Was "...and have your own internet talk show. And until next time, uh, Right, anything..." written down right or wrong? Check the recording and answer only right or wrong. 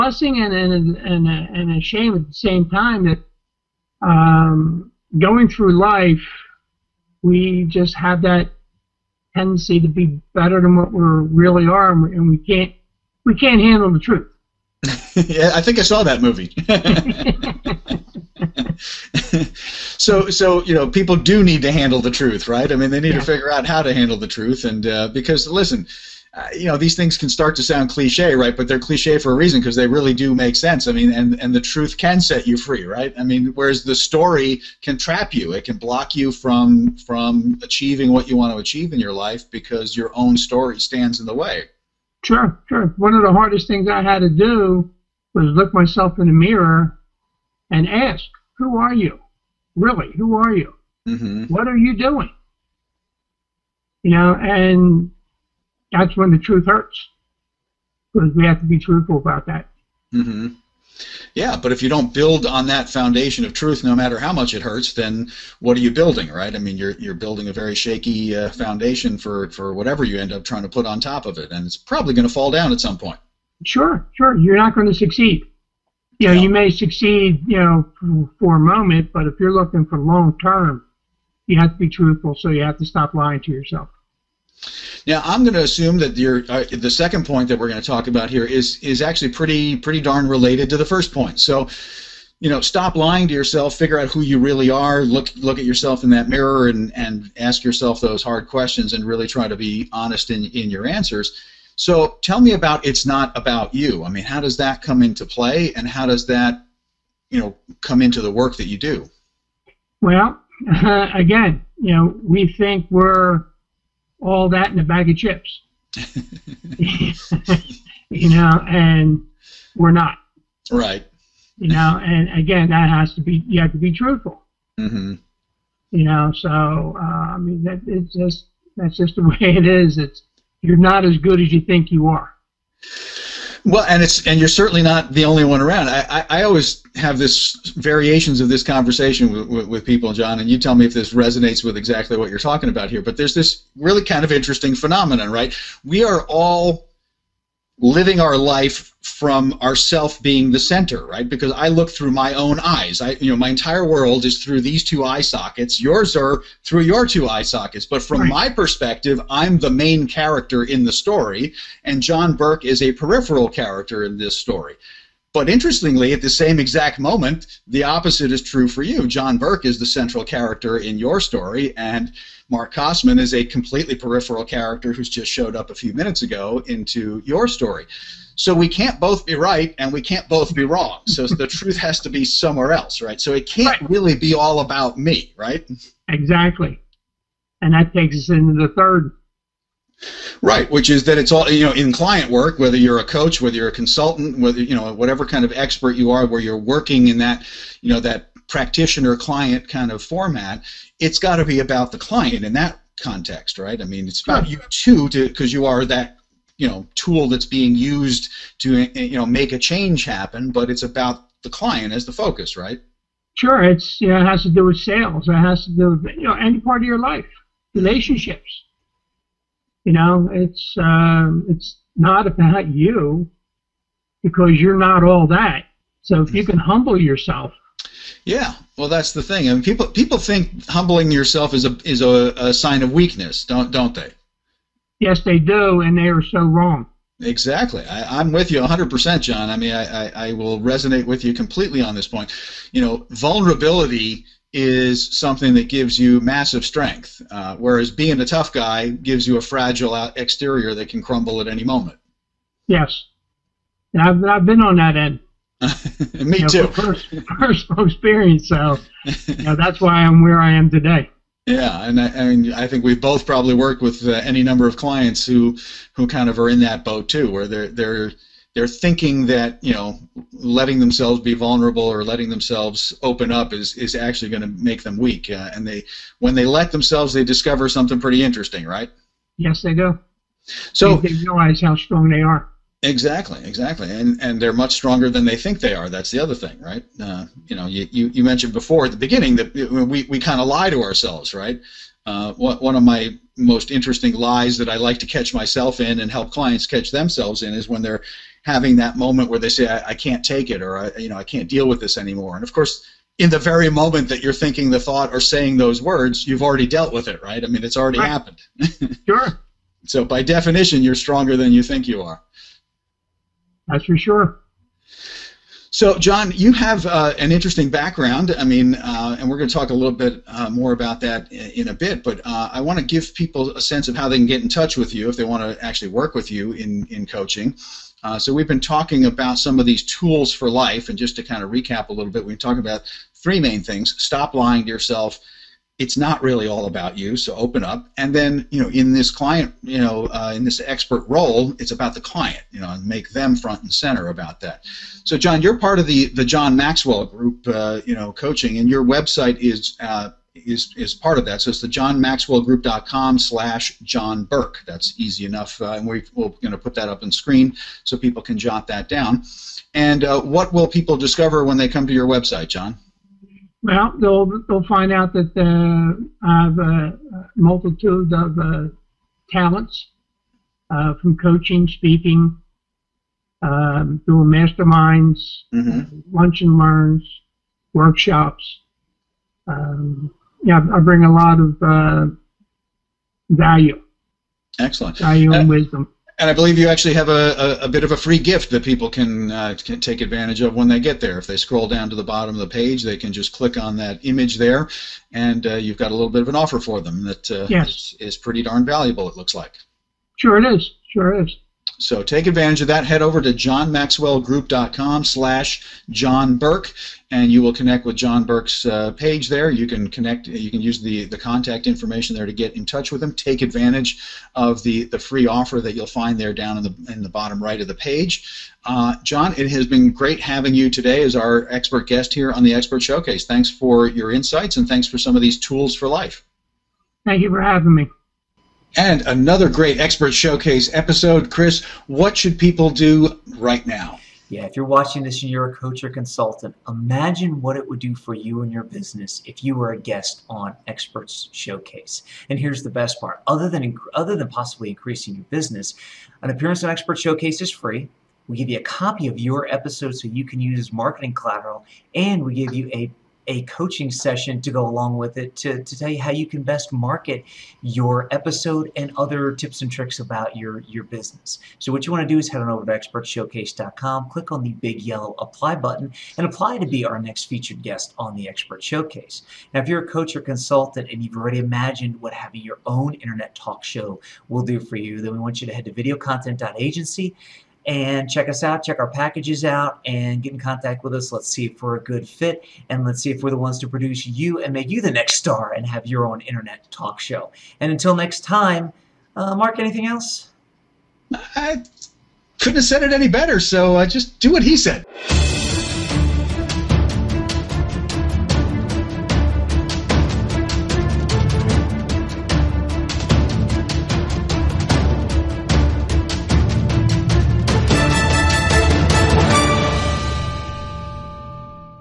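wrong.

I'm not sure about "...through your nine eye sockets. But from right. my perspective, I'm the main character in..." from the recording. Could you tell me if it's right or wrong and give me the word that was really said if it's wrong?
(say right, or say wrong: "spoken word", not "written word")
wrong: "two", not "nine".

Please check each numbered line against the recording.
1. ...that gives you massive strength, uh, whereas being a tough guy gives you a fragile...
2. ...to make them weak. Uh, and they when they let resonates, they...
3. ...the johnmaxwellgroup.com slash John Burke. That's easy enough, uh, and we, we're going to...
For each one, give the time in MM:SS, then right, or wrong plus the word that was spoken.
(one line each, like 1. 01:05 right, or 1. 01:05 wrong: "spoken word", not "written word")
1. 04:05 right
2. 04:34 wrong: "themselves", not "resonates"
3. 05:51 right.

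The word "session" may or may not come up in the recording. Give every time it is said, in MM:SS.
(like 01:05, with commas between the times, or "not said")
07:33.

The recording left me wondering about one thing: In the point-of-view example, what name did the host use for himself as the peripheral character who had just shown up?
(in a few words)
Mark Kosman.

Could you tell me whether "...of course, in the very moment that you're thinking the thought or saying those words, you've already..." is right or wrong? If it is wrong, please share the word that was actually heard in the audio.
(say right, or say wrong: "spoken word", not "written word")
right.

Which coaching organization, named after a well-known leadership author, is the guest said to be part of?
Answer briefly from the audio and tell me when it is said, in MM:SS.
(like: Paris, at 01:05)
The John Maxwell Group, at 05:46.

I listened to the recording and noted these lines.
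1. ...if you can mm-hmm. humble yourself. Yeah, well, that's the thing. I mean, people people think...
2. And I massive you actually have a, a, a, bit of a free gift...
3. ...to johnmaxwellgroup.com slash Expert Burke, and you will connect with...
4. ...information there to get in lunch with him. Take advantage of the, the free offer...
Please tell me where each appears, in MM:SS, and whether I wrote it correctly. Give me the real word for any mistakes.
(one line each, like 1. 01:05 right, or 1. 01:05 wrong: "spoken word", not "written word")
1. 03:46 right
2. 06:26 wrong: "believe", not "massive"
3. 06:43 wrong: "John", not "Expert"
4. 06:51 wrong: "touch", not "lunch".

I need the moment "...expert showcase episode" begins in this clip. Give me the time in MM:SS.
07:09.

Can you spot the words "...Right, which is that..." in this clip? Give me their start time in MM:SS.
03:10.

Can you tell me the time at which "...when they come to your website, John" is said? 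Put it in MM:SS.
06:01.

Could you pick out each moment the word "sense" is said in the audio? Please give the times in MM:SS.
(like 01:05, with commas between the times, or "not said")
00:30, 05:23.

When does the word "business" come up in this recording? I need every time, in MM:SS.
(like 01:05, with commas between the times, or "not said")
07:18, 07:25, 07:40.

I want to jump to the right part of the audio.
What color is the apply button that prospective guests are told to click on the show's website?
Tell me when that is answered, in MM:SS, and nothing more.
07:44.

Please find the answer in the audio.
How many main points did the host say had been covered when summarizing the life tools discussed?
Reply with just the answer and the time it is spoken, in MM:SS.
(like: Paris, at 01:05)
3, at 05:33.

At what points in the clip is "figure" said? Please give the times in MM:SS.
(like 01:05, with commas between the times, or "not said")
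00:23, 01:33.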